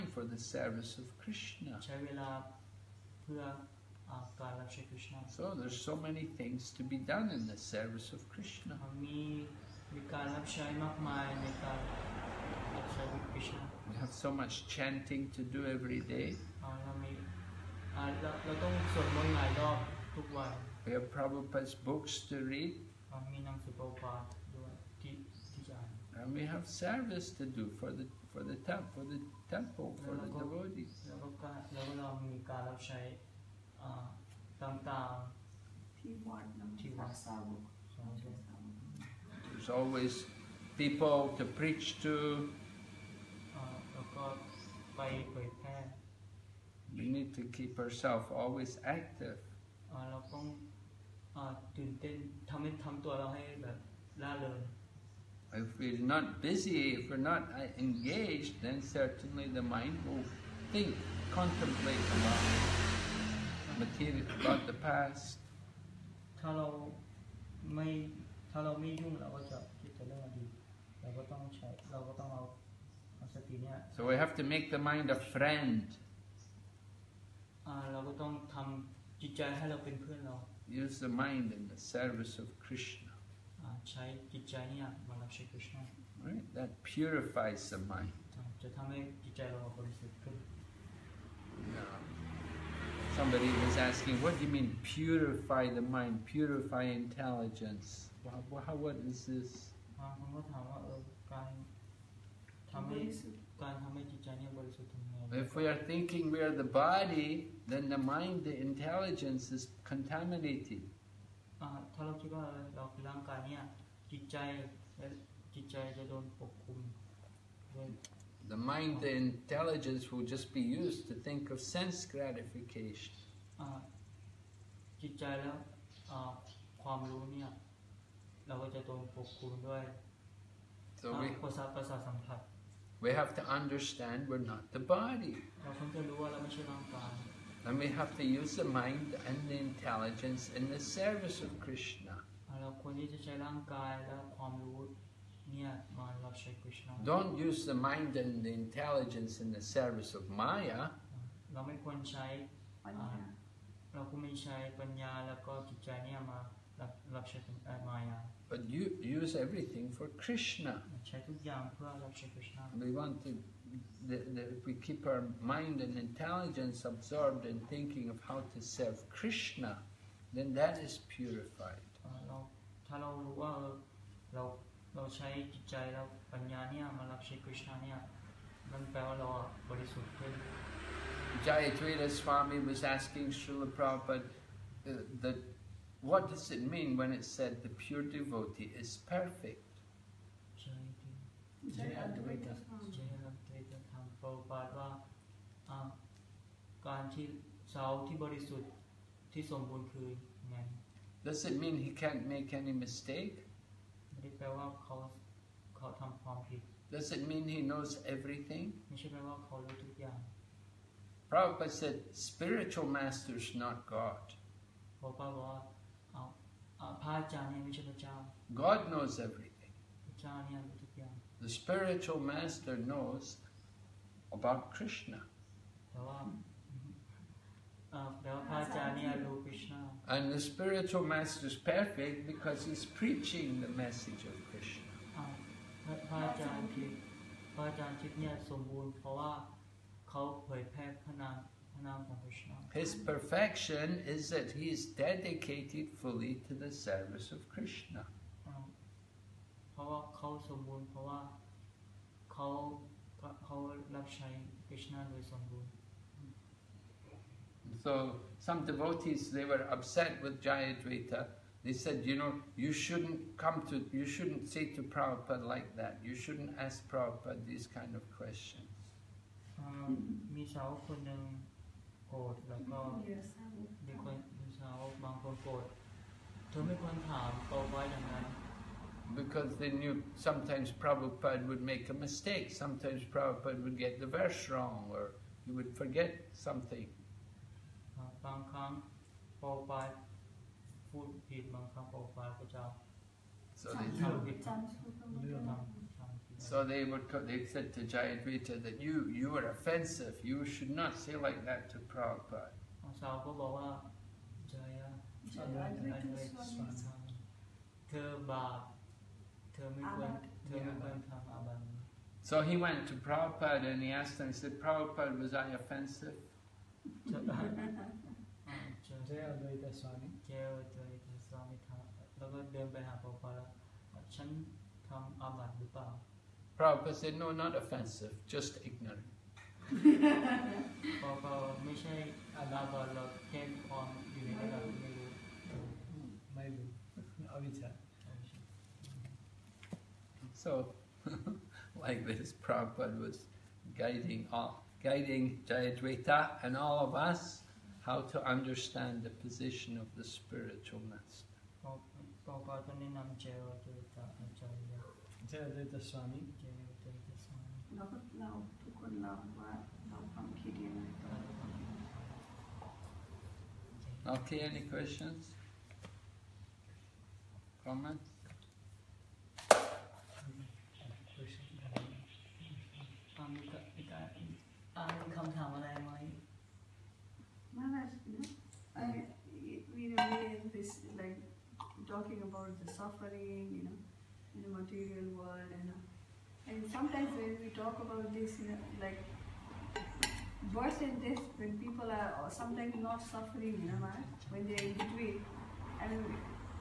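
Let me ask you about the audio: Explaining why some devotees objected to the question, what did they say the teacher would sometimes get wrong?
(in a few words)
The verse.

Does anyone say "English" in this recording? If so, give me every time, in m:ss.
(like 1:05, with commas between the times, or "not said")
not said.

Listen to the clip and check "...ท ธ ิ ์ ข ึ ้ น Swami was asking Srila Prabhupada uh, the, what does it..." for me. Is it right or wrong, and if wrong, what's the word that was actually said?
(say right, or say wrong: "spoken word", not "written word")
right.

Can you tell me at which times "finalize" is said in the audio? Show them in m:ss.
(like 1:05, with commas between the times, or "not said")
not said.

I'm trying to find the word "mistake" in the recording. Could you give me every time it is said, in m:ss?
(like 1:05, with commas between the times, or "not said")
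3:22, 4:41.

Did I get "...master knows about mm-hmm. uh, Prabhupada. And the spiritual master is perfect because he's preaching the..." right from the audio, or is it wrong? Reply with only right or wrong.
wrong.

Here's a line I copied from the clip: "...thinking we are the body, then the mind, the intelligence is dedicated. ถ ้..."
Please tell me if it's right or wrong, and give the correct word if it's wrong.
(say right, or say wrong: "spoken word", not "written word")
wrong: "contaminated", not "dedicated".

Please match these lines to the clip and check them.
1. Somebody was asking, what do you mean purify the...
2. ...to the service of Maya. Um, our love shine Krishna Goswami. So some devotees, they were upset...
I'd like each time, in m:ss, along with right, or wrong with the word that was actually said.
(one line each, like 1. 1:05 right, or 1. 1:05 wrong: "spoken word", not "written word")
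1. 1:33 right
2. 4:06 wrong: "Krishna", not "Maya".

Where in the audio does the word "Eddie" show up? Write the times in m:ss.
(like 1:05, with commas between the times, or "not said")
not said.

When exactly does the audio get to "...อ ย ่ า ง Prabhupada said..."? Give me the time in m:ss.
3:30.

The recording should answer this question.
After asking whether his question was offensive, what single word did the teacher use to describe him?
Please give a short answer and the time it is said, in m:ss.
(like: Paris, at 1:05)
Ignorant, at 5:28.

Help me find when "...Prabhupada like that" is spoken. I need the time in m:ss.
4:24.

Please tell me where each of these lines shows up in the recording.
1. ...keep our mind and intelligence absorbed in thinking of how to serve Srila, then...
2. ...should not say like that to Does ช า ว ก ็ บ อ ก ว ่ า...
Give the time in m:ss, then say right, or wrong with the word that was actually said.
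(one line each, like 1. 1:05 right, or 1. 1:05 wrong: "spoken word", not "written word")
1. 2:44 wrong: "Krishna", not "Srila"
2. 5:00 wrong: "Prabhupada", not "Does".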